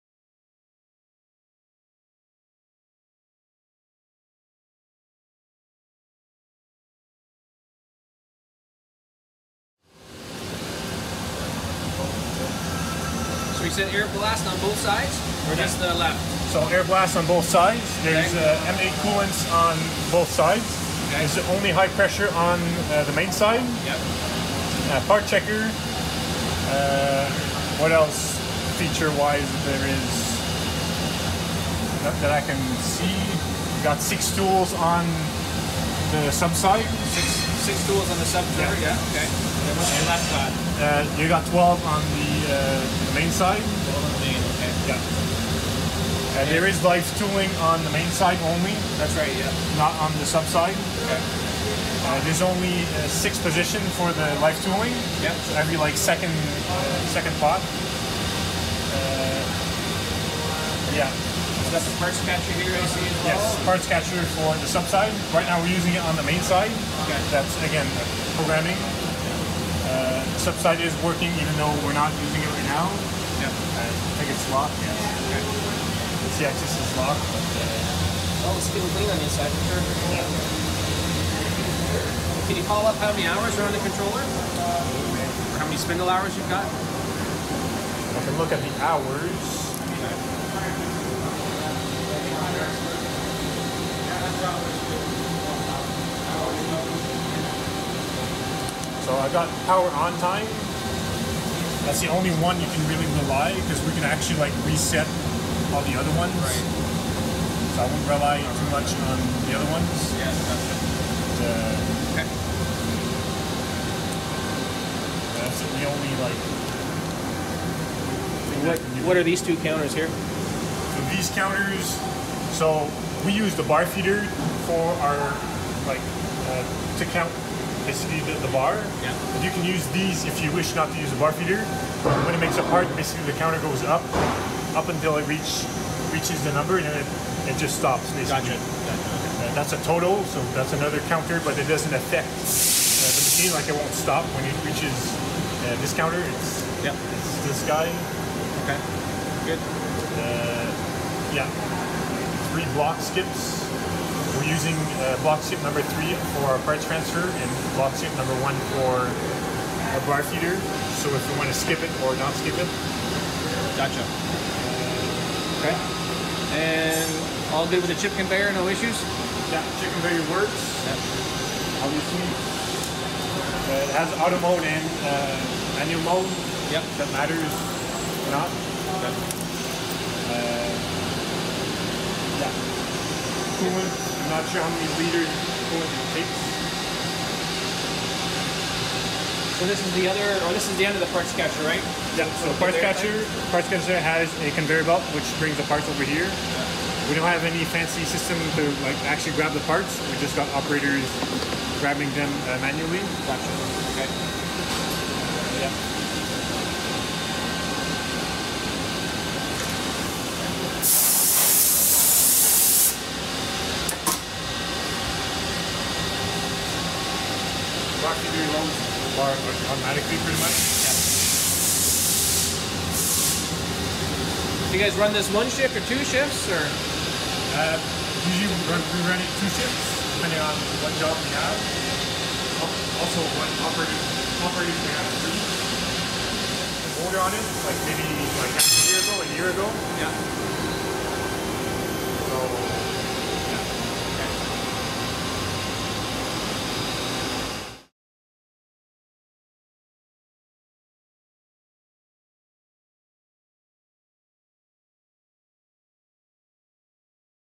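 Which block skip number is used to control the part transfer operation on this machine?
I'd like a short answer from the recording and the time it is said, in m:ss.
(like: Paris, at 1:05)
3, at 2:35.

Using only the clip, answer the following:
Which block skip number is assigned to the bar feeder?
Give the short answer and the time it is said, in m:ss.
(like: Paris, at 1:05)
1, at 2:37.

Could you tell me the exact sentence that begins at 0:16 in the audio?
So air blast on both sides.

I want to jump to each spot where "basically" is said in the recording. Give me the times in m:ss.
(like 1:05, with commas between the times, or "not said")
2:07, 2:12, 2:18.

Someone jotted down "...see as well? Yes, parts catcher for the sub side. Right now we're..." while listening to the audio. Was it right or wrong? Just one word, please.
right.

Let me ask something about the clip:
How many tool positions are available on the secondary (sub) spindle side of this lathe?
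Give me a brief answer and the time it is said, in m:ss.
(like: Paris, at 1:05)
6, at 0:33.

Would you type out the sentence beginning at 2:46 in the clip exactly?
And all good with the chip conveyor, no issues?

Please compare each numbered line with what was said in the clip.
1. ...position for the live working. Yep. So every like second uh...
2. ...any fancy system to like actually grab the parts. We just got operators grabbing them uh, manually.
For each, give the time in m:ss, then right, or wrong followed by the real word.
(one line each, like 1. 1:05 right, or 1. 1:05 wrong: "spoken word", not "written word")
1. 0:53 wrong: "tooling", not "working"
2. 3:17 right.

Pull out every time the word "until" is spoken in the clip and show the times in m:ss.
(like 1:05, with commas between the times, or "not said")
2:14.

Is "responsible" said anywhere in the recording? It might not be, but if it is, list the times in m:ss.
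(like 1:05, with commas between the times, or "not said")
not said.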